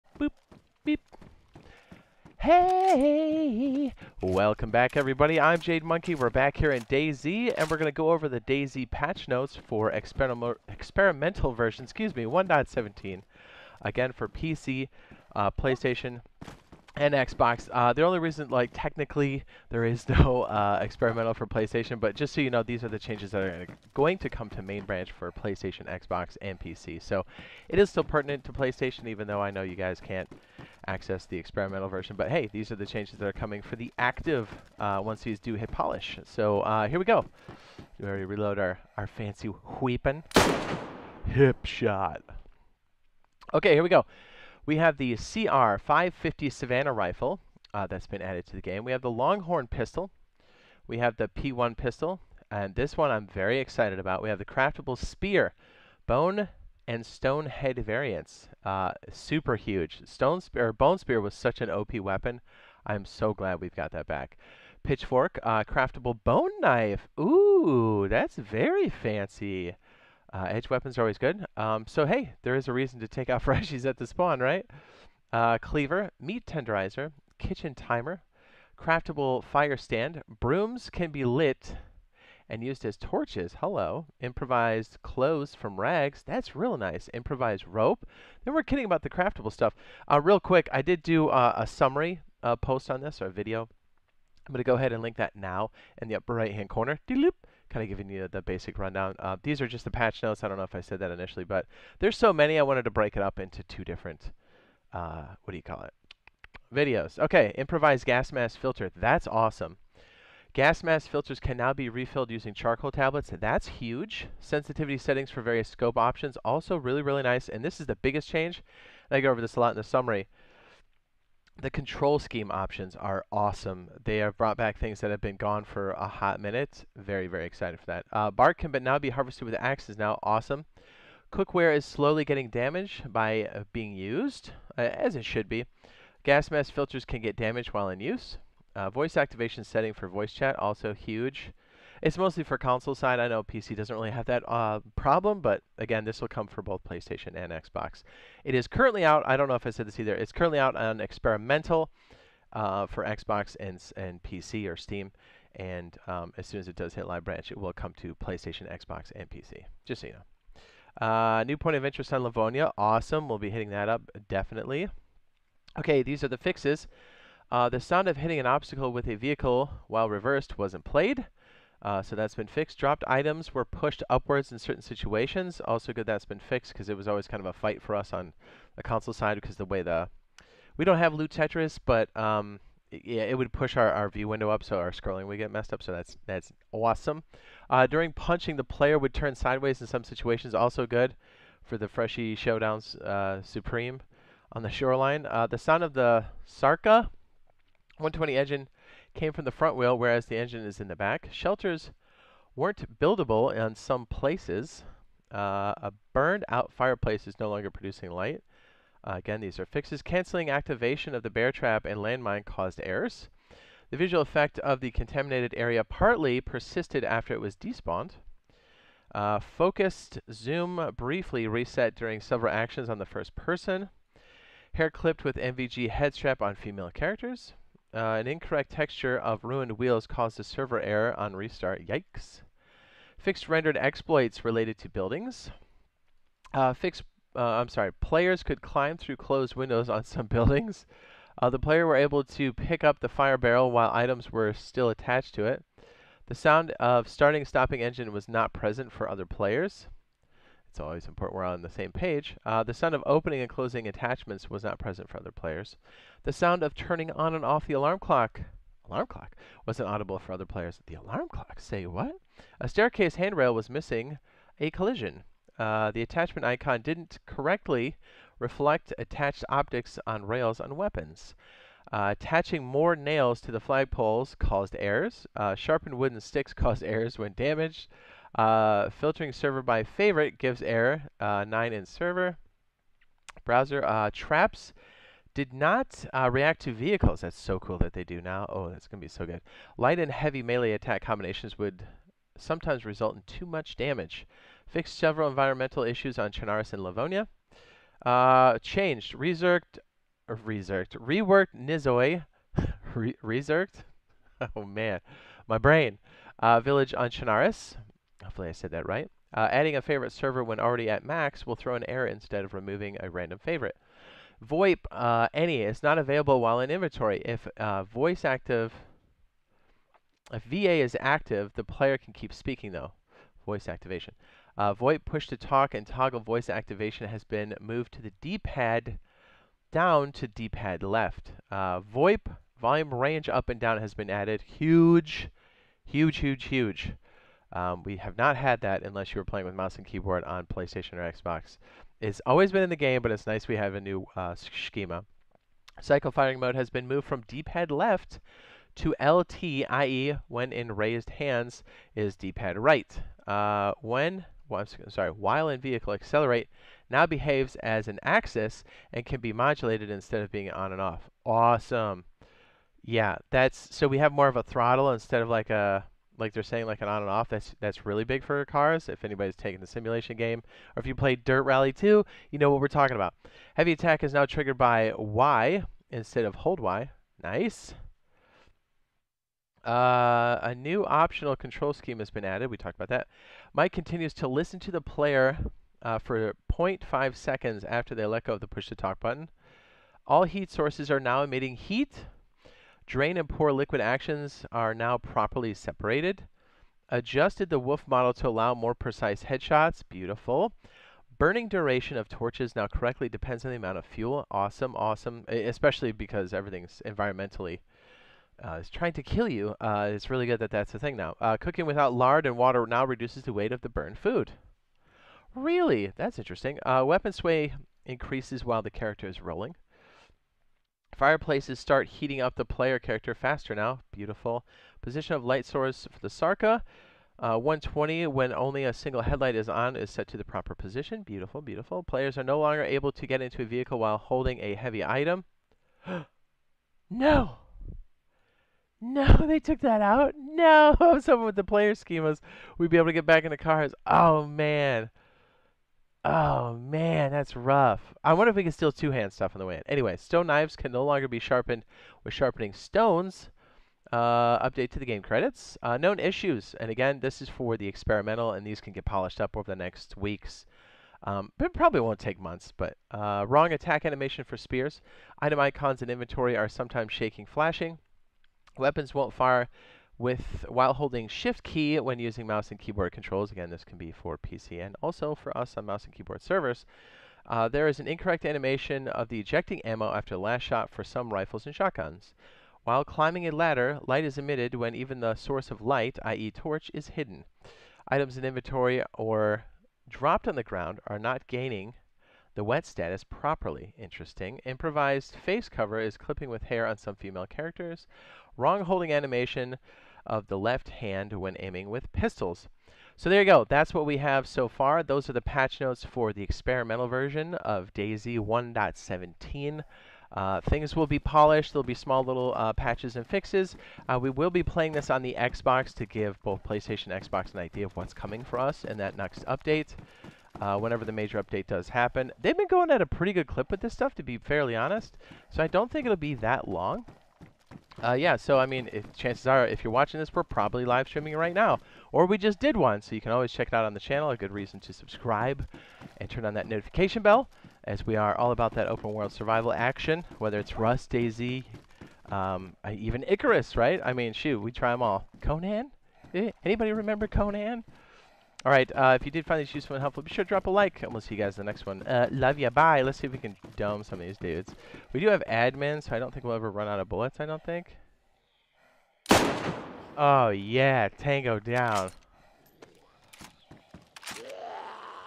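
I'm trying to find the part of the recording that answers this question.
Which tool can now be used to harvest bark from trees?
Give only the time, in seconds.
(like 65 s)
129 s.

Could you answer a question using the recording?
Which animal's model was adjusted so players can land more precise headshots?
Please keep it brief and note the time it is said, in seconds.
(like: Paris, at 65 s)
Wolf, at 397 s.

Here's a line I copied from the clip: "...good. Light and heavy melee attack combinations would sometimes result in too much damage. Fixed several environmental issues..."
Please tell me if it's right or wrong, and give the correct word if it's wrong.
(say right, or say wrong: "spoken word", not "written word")
right.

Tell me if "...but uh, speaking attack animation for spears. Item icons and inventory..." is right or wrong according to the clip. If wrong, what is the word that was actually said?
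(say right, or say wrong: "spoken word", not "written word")
wrong: "wrong", not "speaking".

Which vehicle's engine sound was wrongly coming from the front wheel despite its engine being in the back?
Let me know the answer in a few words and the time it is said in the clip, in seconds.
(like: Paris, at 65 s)
Sarka 120, at 196 s.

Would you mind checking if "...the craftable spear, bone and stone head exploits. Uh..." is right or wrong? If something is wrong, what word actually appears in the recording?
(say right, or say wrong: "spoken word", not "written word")
wrong: "variants", not "exploits".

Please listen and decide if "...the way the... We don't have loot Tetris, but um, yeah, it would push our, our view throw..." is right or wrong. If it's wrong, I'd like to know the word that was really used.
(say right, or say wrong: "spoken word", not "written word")
wrong: "window", not "throw".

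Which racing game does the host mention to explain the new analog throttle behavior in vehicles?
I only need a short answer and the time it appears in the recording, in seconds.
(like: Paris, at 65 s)
Dirt Rally 2, at 371 s.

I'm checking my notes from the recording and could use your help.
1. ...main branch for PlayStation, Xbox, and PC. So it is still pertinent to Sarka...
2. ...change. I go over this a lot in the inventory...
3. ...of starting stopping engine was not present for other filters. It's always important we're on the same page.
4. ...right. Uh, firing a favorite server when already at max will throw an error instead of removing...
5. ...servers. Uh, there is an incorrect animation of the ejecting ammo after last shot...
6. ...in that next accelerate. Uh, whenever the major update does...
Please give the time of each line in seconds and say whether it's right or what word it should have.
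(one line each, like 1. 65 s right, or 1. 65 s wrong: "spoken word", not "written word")
1. 24 s wrong: "PlayStation", not "Sarka"
2. 118 s wrong: "summary", not "inventory"
3. 246 s wrong: "players", not "filters"
4. 308 s wrong: "adding", not "firing"
5. 476 s right
6. 518 s wrong: "update", not "accelerate".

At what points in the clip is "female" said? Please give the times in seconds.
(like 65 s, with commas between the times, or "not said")
226 s, 496 s.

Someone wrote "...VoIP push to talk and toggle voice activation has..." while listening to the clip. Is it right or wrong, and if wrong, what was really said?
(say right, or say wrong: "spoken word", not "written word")
right.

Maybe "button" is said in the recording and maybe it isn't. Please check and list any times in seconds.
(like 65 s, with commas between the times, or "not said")
388 s.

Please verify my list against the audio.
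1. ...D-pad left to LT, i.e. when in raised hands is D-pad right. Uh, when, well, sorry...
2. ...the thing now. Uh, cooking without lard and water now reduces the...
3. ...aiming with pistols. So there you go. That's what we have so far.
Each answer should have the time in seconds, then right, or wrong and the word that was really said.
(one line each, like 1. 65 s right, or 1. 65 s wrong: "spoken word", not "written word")
1. 347 s right
2. 410 s right
3. 501 s right.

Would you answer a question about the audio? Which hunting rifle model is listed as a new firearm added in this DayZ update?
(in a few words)
CR 550 Savanna.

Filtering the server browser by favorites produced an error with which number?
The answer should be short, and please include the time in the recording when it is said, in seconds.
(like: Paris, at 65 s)
9, at 281 s.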